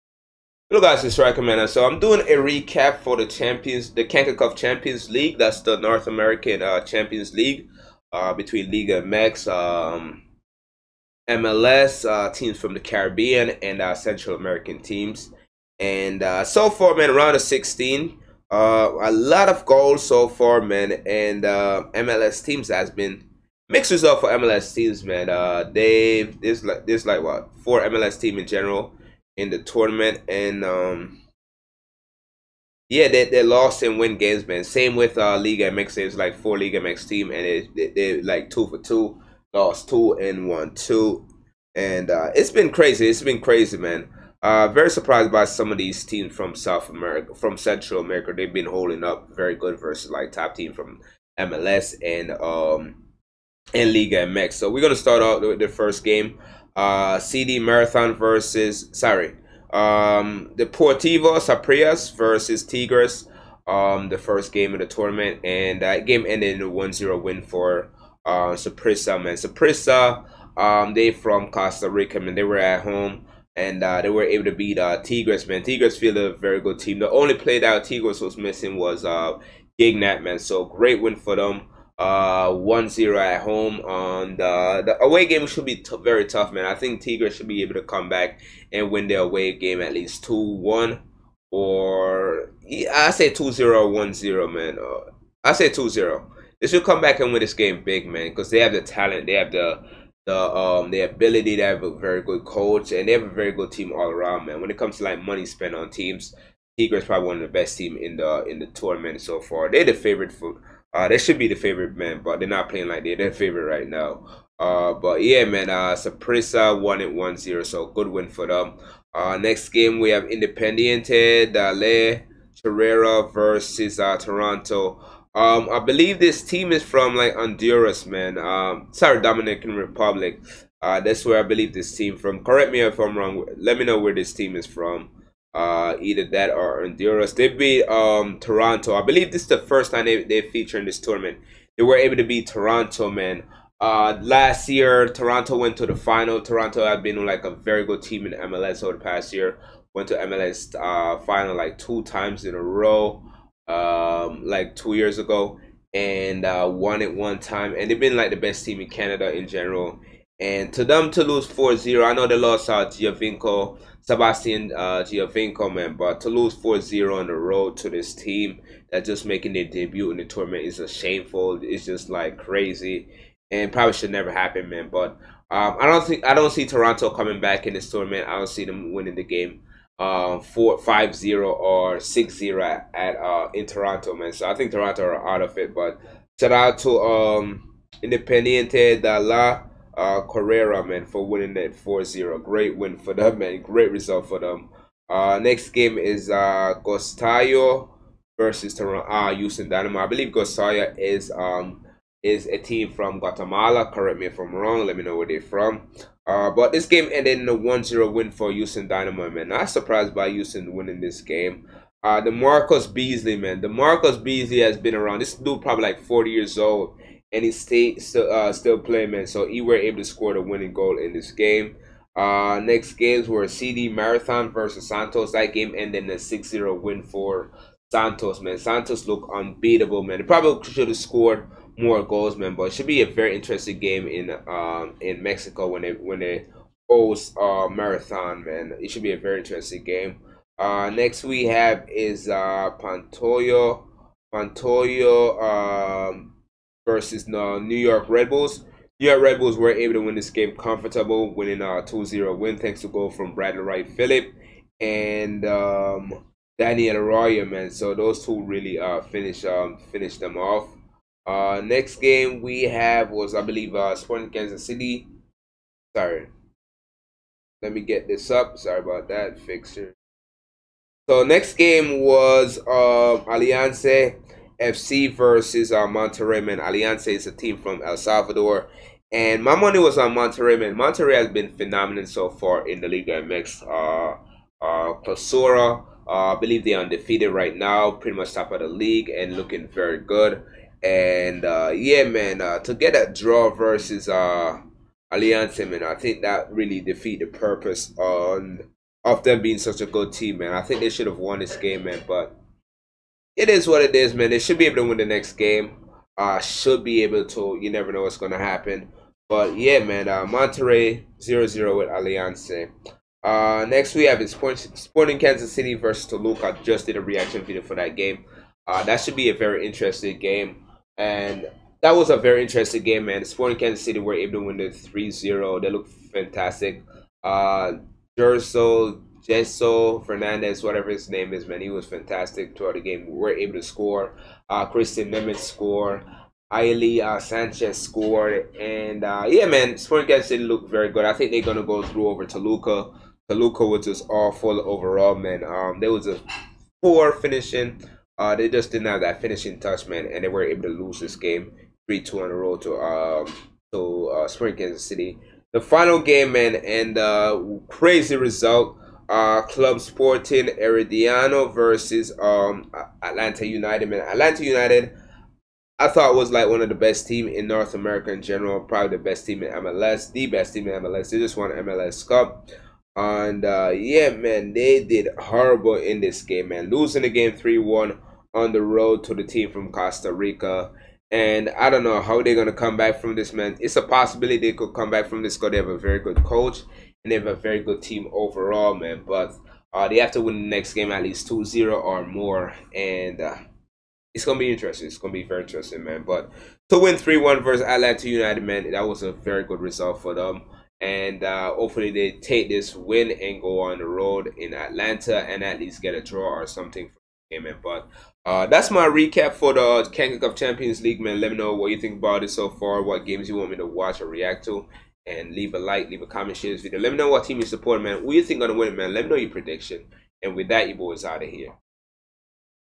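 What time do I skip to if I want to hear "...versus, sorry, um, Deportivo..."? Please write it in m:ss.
0:58.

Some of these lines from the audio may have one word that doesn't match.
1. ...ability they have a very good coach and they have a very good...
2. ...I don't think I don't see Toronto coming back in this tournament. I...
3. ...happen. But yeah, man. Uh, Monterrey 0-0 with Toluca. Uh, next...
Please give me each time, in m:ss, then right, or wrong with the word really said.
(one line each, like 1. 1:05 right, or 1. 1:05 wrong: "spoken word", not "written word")
1. 1:41 right
2. 2:55 right
3. 5:08 wrong: "Alianza", not "Toluca".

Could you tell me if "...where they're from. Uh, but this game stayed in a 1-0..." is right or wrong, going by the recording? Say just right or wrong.
wrong.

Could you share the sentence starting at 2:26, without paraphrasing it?
Toronto had been like a very good team in MLS over the past year.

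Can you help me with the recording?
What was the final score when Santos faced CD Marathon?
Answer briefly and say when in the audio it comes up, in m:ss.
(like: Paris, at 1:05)
6-0, at 3:46.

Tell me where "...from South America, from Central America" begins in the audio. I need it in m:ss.
0:46.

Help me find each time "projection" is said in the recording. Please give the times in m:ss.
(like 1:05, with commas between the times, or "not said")
not said.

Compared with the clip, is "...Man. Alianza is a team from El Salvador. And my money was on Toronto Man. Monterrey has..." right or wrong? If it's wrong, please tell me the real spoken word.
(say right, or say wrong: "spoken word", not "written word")
wrong: "Monterrey", not "Toronto".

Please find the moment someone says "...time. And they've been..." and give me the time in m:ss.
2:37.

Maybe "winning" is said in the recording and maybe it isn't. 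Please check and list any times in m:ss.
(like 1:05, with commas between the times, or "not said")
2:58, 3:11, 3:30, 3:40, 4:11.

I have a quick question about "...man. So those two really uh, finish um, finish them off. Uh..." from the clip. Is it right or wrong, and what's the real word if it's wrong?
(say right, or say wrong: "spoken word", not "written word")
right.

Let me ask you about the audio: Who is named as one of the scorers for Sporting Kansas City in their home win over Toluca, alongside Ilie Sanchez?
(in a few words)
Christian Nemeth.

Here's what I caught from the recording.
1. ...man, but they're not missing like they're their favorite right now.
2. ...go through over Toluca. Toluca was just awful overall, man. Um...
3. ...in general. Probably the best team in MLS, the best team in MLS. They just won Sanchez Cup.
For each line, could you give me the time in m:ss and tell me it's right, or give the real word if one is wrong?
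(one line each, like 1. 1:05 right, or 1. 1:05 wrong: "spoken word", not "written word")
1. 1:51 wrong: "playing", not "missing"
2. 5:41 right
3. 6:08 wrong: "MLS", not "Sanchez".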